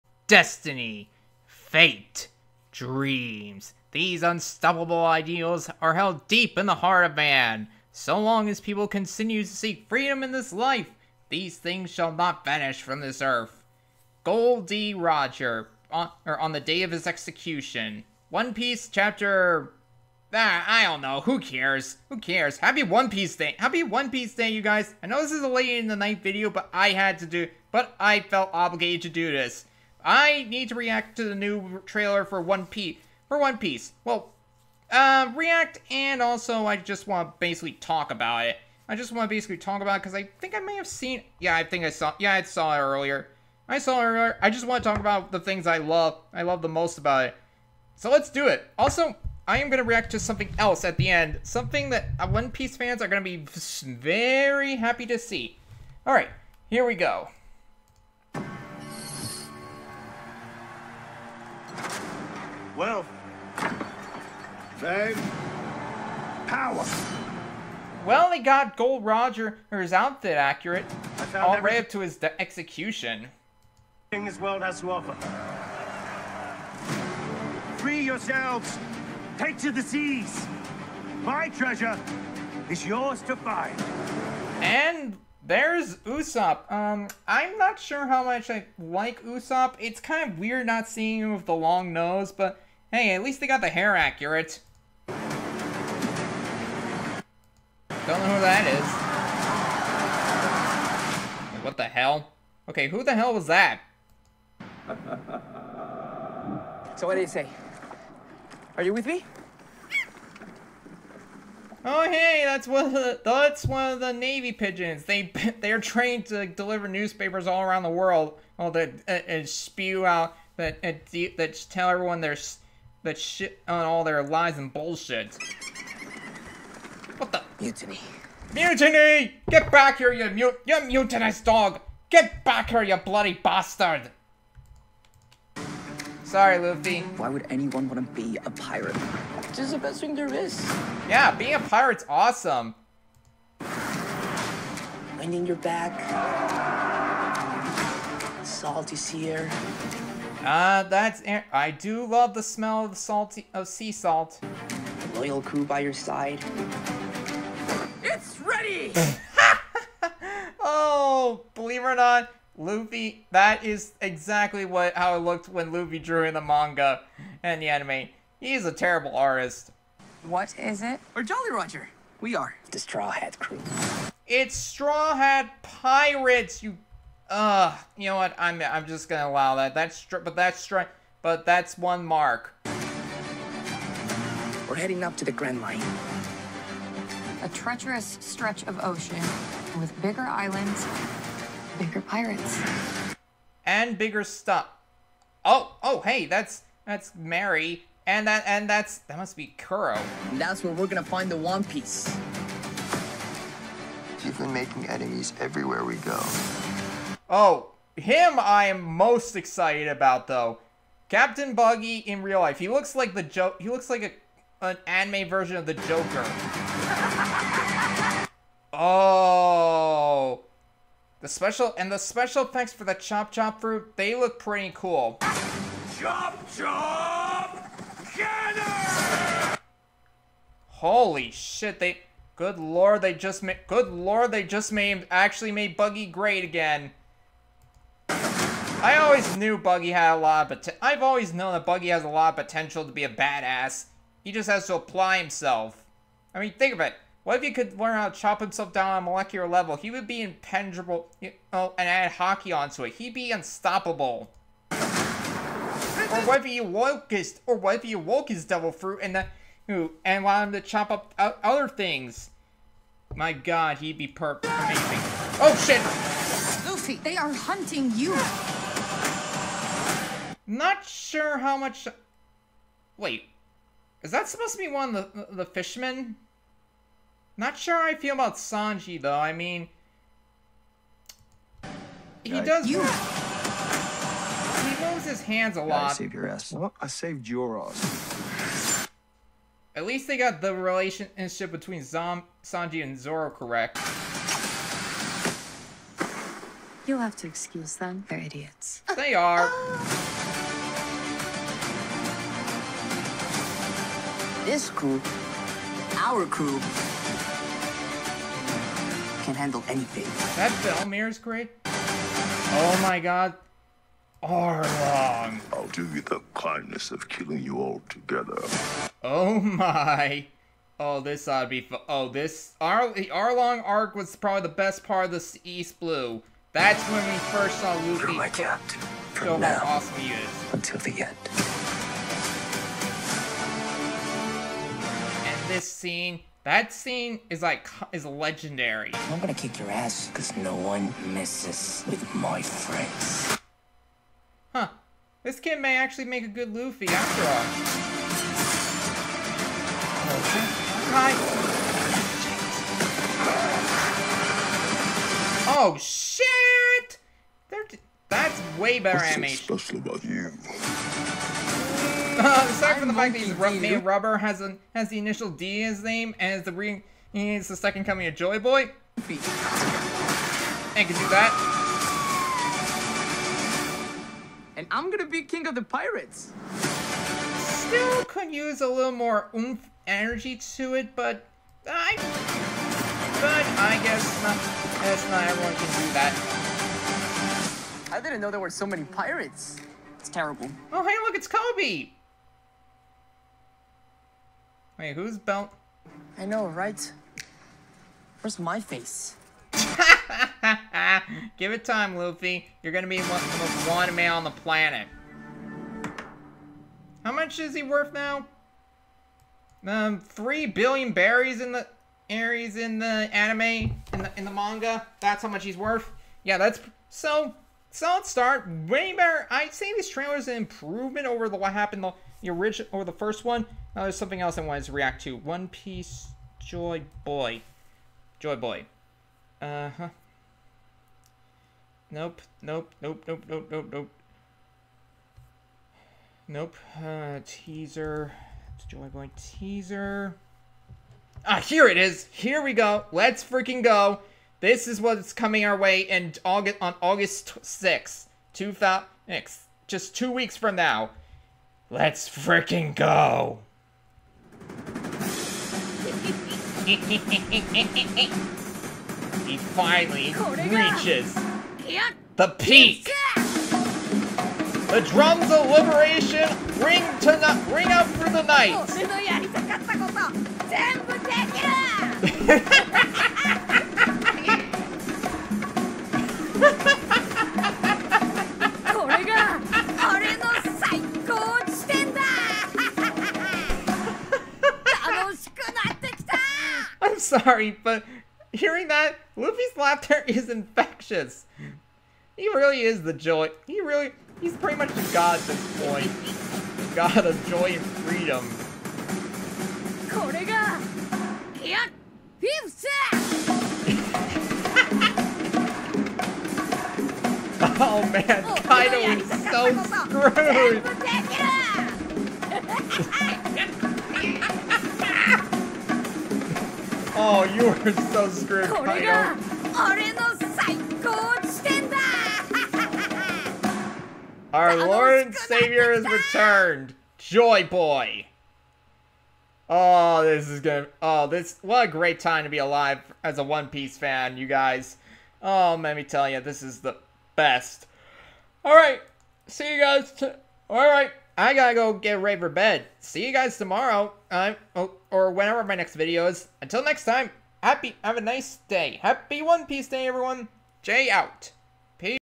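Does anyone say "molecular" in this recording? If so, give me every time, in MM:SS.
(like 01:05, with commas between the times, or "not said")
04:09.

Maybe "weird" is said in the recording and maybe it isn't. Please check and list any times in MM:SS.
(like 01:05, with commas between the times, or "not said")
01:30.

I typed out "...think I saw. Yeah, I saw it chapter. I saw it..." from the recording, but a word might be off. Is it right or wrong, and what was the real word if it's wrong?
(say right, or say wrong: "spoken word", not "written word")
wrong: "earlier", not "chapter".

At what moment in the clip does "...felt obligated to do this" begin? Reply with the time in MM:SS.
00:28.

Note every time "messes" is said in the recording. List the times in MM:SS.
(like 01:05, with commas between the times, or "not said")
05:41.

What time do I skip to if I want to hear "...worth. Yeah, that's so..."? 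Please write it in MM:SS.
06:55.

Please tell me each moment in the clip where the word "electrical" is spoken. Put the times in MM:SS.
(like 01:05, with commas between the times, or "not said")
not said.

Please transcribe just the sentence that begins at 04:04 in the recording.
He just has to apply himself.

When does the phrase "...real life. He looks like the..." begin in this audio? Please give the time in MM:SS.
03:32.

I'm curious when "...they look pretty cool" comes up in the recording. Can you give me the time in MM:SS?
03:43.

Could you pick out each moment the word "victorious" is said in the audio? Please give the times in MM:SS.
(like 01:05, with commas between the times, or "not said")
not said.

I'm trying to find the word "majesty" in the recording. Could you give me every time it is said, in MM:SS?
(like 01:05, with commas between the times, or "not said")
not said.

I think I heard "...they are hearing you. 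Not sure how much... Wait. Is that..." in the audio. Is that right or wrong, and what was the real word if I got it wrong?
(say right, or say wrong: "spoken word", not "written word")
wrong: "hunting", not "hearing".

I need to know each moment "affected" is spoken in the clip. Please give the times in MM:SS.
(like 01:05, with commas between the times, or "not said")
not said.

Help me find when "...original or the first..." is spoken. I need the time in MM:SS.
07:02.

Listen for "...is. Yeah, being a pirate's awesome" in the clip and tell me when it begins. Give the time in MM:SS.
02:20.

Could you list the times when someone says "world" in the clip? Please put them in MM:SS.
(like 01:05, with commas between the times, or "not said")
01:14, 01:57.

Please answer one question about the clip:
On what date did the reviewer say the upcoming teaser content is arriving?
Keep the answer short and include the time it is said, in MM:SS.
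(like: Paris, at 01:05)
August 6th, at 07:26.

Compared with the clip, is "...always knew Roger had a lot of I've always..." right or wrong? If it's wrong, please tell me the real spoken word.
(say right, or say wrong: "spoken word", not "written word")
wrong: "Buggy", not "Roger".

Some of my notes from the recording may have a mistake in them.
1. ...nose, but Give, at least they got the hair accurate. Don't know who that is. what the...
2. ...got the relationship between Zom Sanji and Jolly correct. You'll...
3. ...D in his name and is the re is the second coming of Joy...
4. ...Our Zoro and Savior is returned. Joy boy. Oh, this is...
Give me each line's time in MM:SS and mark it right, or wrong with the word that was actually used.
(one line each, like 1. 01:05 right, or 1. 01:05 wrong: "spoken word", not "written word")
1. 01:31 wrong: "Hey", not "Give"
2. 04:50 wrong: "Zoro", not "Jolly"
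3. 06:05 right
4. 08:44 wrong: "Lord", not "Zoro".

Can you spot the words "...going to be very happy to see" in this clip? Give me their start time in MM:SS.
00:53.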